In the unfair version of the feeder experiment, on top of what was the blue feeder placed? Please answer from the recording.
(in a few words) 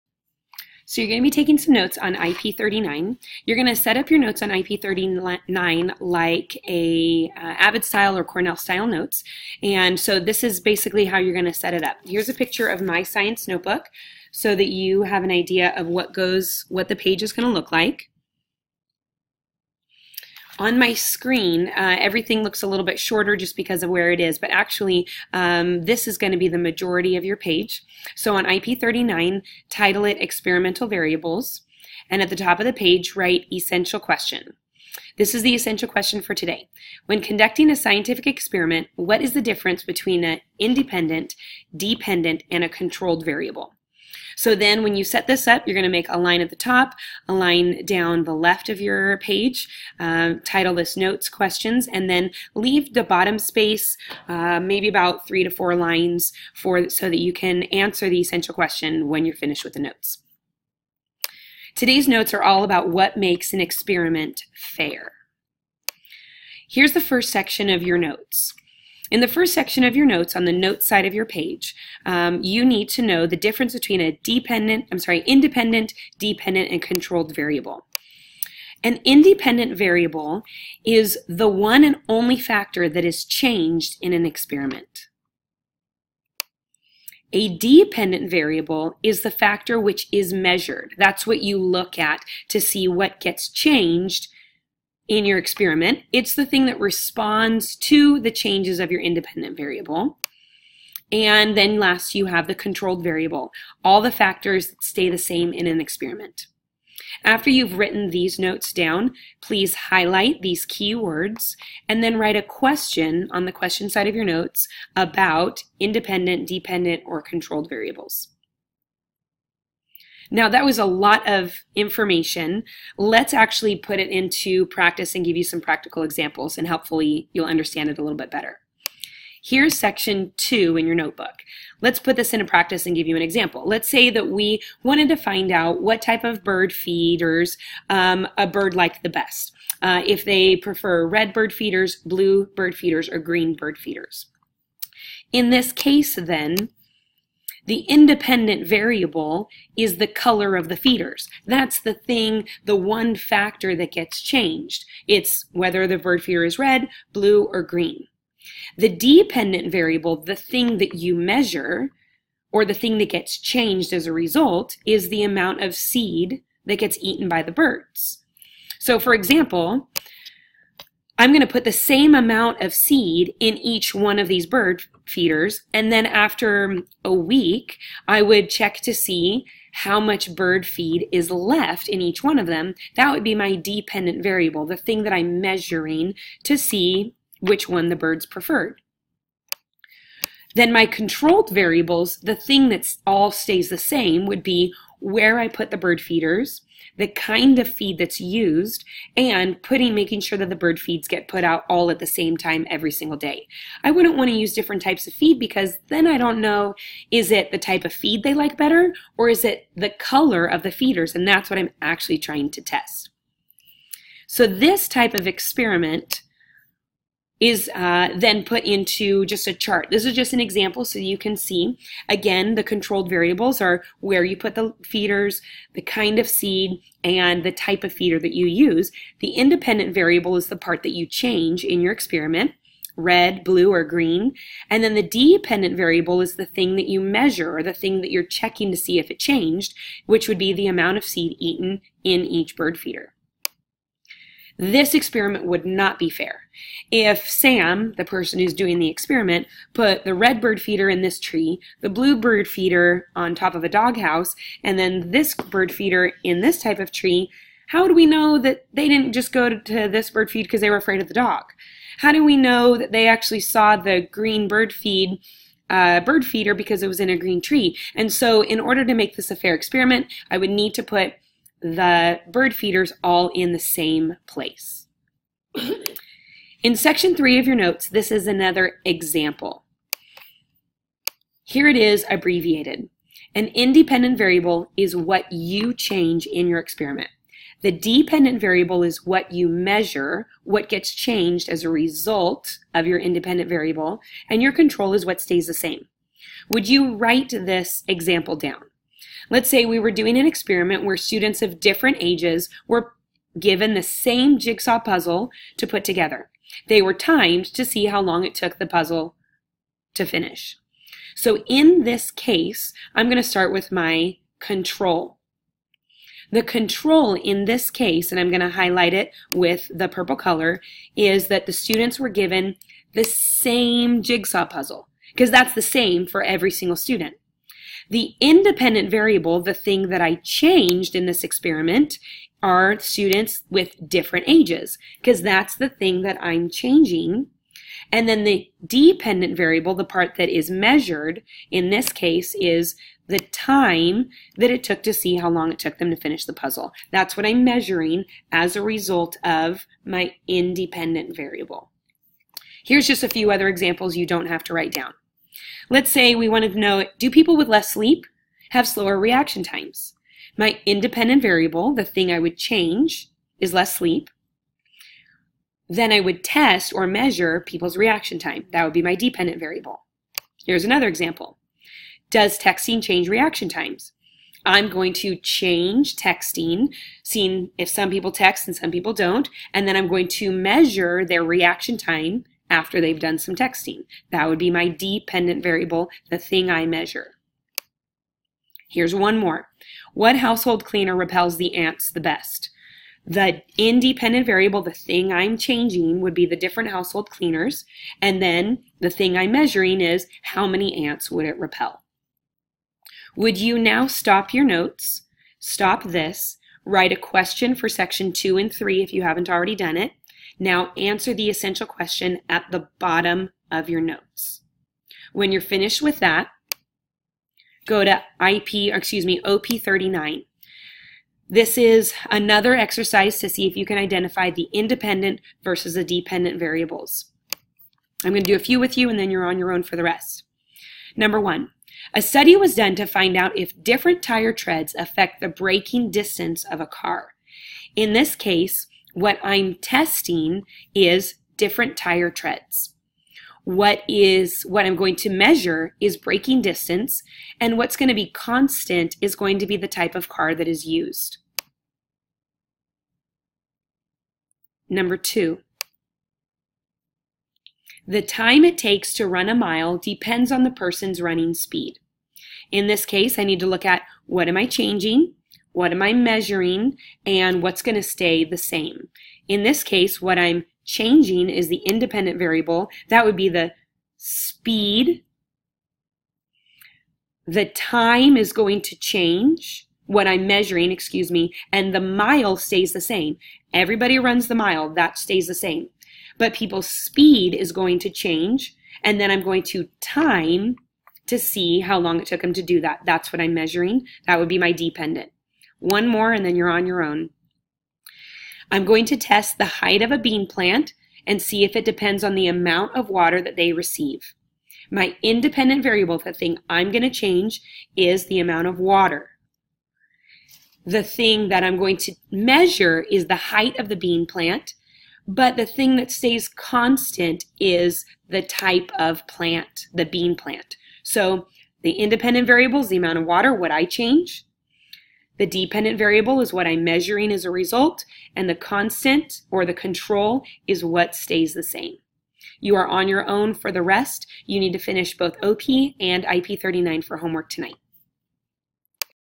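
a doghouse.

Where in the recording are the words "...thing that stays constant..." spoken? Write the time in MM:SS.
08:35.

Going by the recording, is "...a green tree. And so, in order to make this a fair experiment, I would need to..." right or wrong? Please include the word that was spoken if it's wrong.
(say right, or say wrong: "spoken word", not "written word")
right.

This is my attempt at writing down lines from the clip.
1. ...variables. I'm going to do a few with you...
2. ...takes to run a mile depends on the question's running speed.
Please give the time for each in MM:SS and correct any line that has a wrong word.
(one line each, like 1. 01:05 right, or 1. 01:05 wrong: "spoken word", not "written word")
1. 07:06 right
2. 07:38 wrong: "person", not "question".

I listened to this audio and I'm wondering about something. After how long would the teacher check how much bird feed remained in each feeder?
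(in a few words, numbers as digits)
a week.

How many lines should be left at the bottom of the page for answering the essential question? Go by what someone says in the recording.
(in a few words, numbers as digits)
three to four.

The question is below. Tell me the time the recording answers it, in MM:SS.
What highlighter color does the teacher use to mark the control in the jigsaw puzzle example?
05:19.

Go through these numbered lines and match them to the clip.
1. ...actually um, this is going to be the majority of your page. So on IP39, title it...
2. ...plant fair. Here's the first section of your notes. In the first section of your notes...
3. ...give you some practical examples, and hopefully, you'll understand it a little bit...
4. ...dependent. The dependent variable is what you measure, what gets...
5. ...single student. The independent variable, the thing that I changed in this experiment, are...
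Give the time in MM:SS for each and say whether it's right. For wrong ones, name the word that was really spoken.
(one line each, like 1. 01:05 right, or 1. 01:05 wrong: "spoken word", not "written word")
1. 00:24 right
2. 01:03 wrong: "experiment", not "plant"
3. 02:05 right
4. 04:46 wrong: "experiment", not "dependent"
5. 05:26 right.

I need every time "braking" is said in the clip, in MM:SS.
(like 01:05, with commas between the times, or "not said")
07:15, 07:25.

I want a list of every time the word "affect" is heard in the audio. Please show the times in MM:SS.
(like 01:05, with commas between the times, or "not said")
07:14.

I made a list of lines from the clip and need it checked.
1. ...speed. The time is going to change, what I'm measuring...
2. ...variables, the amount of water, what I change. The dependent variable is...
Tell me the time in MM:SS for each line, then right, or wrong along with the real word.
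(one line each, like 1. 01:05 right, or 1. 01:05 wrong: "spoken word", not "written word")
1. 07:53 right
2. 08:42 right.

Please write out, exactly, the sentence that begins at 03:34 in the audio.
So, this type of experiment is uh, then put into just a chart.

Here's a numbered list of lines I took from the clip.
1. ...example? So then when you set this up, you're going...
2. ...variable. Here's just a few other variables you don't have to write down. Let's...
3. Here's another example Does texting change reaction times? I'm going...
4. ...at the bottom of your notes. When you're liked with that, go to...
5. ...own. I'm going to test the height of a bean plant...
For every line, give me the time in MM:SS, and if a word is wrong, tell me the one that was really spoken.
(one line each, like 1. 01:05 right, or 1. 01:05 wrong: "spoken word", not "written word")
1. 00:43 wrong: "variable", not "example"
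2. 05:51 wrong: "examples", not "variables"
3. 06:10 right
4. 06:52 wrong: "finished", not "liked"
5. 08:16 right.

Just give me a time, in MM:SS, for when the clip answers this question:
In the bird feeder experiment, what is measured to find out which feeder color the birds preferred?
02:45.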